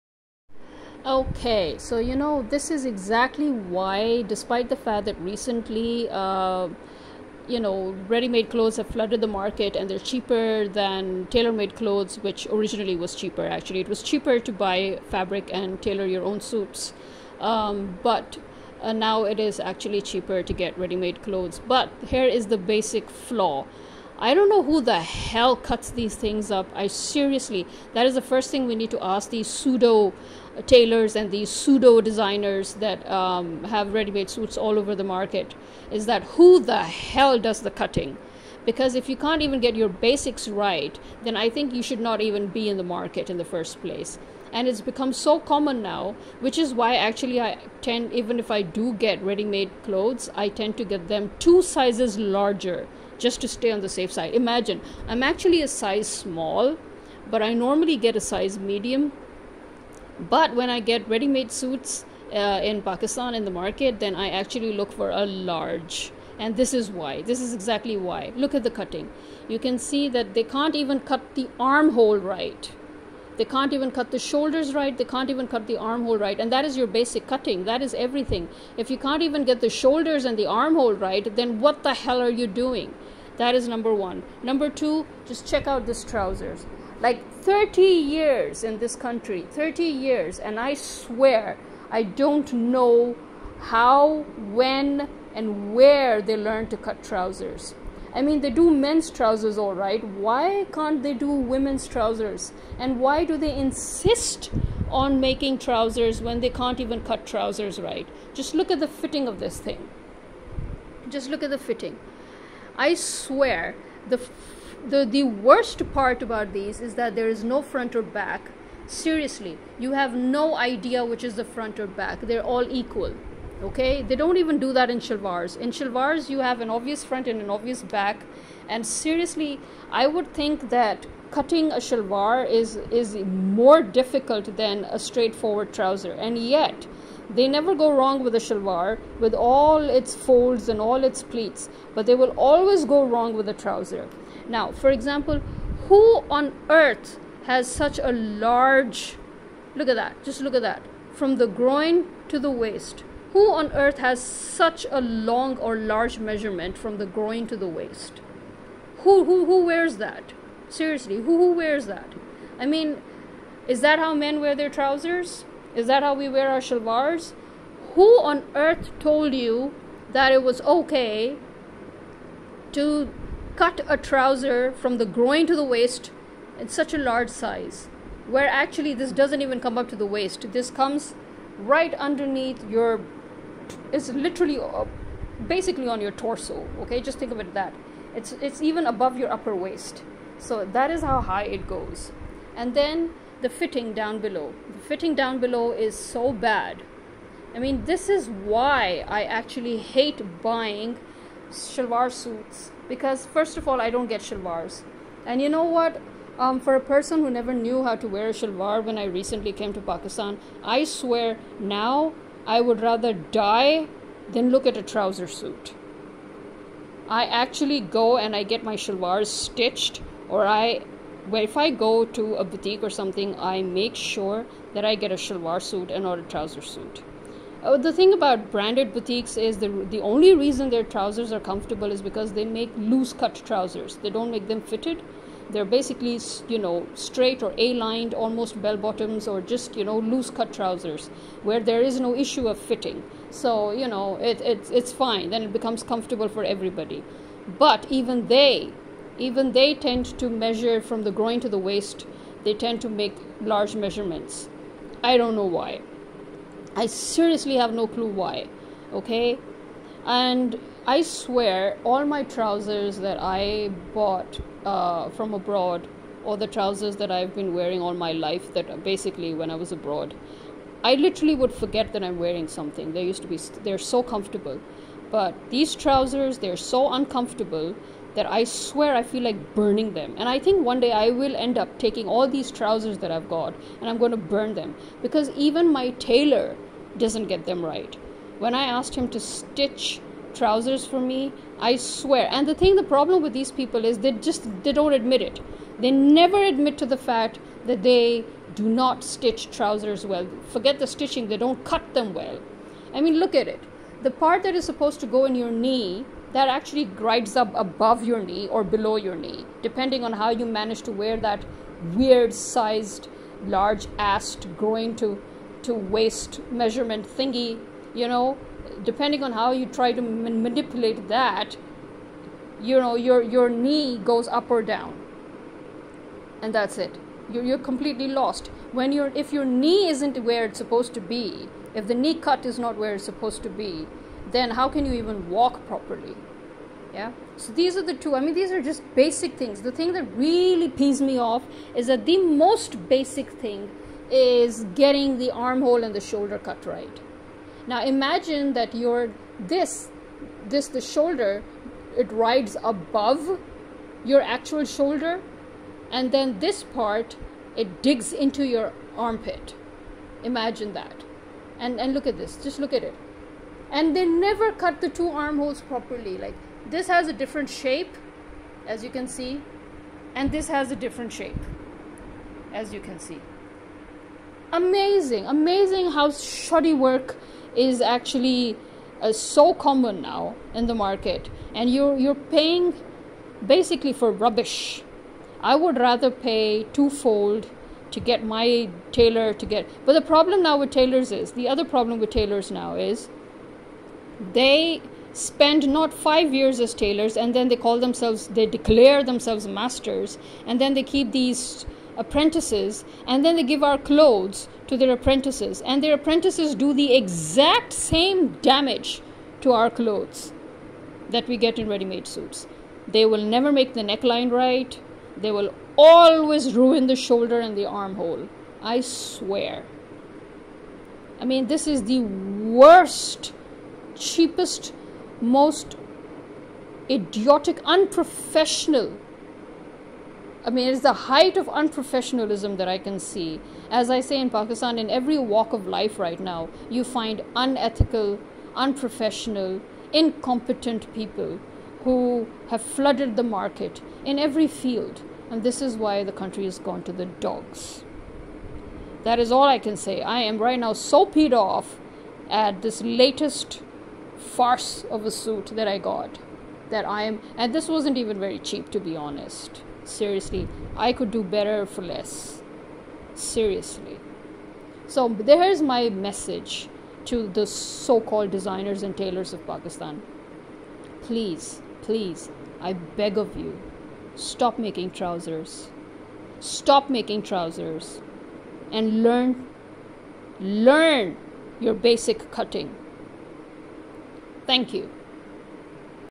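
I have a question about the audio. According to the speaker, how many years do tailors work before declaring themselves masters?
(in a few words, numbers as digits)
5 years.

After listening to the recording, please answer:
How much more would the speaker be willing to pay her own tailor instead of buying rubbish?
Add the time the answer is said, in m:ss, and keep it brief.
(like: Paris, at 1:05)
twofold, at 6:26.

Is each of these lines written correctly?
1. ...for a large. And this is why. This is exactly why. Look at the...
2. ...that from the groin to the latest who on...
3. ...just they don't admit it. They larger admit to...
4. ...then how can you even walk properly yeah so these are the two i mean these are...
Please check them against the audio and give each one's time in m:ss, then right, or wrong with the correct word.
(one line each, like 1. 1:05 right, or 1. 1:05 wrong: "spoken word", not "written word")
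1. 1:04 right
2. 2:30 wrong: "waist", not "latest"
3. 4:54 wrong: "never", not "larger"
4. 5:34 right.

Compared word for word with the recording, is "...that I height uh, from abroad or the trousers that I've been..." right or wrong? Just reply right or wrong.
wrong.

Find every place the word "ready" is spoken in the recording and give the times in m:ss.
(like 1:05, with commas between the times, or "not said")
0:08, 0:20, 0:33, 0:49, 1:01, 6:51.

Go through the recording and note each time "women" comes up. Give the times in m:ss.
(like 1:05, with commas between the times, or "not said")
1:41.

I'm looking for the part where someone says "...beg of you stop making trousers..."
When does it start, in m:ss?
7:52.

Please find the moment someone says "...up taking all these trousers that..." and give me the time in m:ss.
4:41.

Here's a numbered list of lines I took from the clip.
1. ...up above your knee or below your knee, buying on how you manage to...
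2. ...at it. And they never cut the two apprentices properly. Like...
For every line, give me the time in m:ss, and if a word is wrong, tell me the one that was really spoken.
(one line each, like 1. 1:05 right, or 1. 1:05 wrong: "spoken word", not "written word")
1. 5:07 wrong: "depending", not "buying"
2. 6:02 wrong: "armholes", not "apprentices".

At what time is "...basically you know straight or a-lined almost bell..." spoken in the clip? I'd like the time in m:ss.
3:55.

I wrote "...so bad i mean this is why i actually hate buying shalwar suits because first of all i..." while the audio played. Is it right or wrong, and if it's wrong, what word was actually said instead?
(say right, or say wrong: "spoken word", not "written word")
right.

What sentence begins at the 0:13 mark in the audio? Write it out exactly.
Actually, it was cheaper to buy fabric and tailor your own suits.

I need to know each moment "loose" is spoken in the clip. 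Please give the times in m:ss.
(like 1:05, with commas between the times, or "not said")
3:52, 3:59.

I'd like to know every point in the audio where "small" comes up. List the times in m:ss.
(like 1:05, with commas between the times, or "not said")
0:56.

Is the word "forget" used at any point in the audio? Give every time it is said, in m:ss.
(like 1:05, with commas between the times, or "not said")
4:31, 5:00.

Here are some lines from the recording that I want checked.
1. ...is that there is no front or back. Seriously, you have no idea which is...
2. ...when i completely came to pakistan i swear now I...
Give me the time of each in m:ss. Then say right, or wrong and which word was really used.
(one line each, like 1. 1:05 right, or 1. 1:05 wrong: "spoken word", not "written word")
1. 1:56 right
2. 3:28 wrong: "recently", not "completely".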